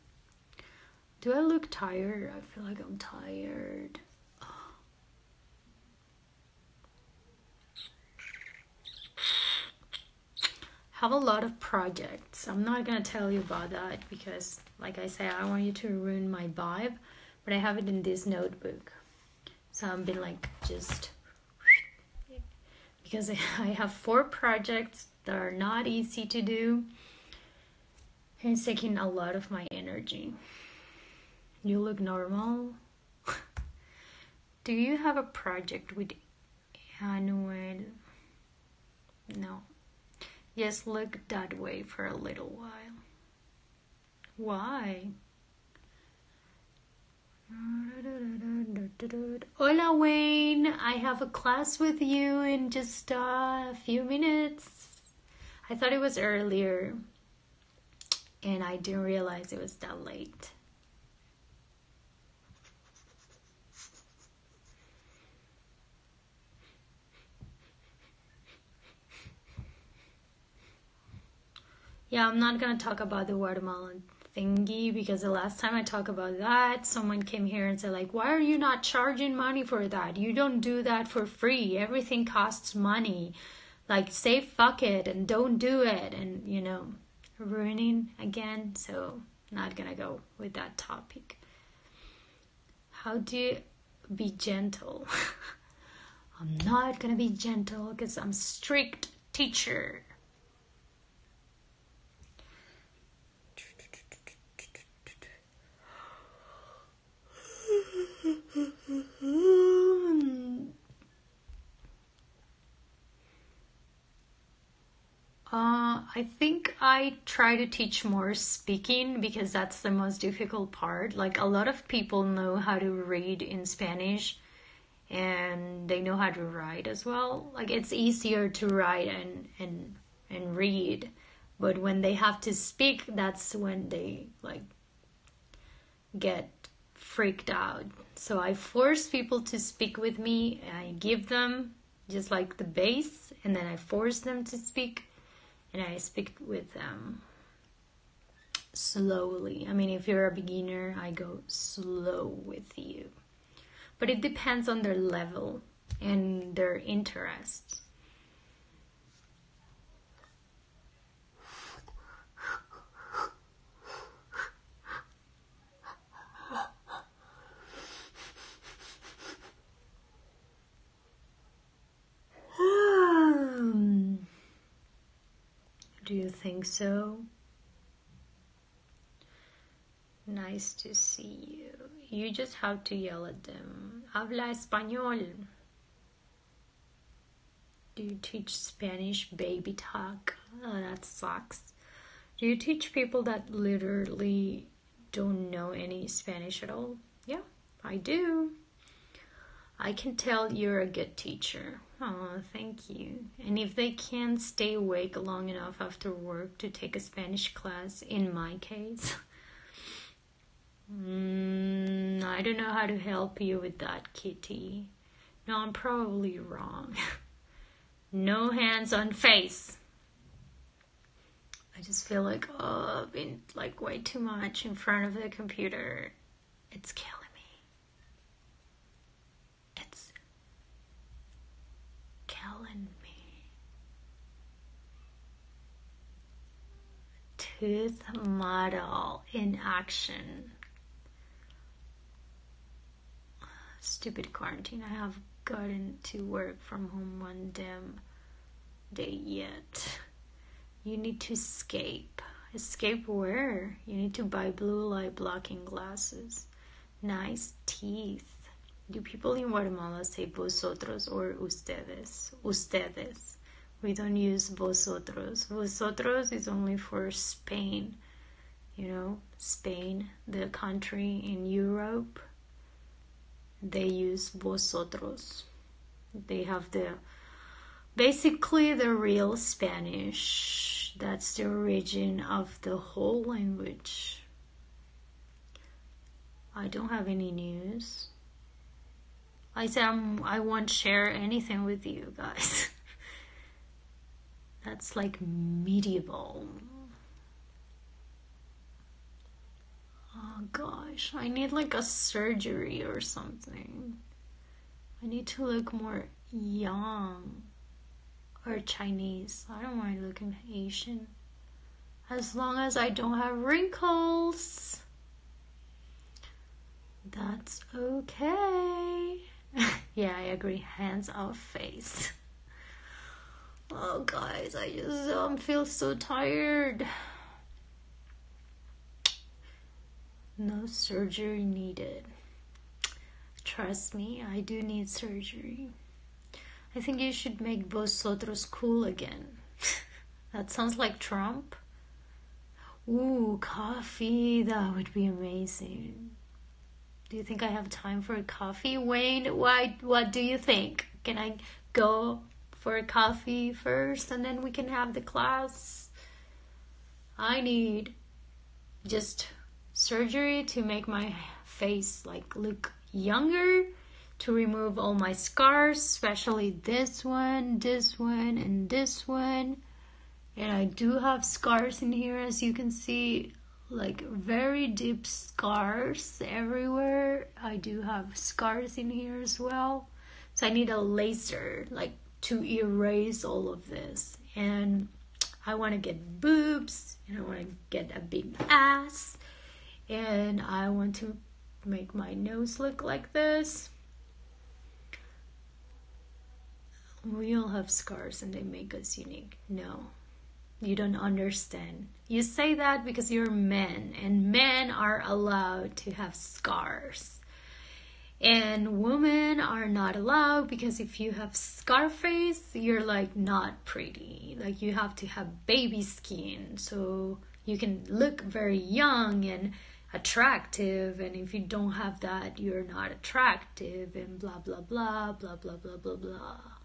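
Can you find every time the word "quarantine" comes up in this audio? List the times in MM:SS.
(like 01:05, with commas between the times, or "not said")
04:04.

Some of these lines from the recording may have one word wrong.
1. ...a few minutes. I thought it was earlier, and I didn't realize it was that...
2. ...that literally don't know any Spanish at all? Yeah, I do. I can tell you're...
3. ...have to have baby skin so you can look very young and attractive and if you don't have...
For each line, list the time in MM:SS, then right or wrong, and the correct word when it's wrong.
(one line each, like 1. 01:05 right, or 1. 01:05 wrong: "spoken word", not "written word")
1. 00:53 right
2. 03:13 right
3. 06:54 right.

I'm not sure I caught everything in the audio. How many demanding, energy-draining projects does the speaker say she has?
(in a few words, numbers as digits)
4.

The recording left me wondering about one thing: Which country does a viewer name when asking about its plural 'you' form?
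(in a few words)
Guatemala.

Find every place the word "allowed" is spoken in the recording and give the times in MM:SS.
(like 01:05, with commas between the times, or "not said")
06:45, 06:49.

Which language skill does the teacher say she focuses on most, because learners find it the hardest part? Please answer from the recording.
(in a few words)
speaking.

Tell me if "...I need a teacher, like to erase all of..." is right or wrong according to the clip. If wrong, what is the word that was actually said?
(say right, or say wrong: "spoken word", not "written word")
wrong: "laser", not "teacher".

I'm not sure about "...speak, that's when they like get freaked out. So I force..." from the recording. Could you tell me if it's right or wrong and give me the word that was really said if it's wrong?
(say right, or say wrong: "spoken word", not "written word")
right.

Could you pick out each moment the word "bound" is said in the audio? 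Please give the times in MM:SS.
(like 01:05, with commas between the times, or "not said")
not said.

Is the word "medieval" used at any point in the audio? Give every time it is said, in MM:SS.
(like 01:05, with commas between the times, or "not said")
04:55.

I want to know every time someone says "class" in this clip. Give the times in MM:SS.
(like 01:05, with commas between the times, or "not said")
00:51, 03:27, 05:55.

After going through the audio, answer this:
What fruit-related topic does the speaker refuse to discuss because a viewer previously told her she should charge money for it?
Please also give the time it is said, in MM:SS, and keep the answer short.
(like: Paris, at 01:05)
watermelon, at 01:13.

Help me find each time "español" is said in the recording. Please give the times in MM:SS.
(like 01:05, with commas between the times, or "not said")
03:04.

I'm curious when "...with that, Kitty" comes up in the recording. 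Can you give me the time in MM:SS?
03:33.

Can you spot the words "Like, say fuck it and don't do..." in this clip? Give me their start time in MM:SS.
01:23.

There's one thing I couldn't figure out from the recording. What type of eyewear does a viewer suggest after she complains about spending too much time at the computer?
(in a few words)
blue light blocking glasses.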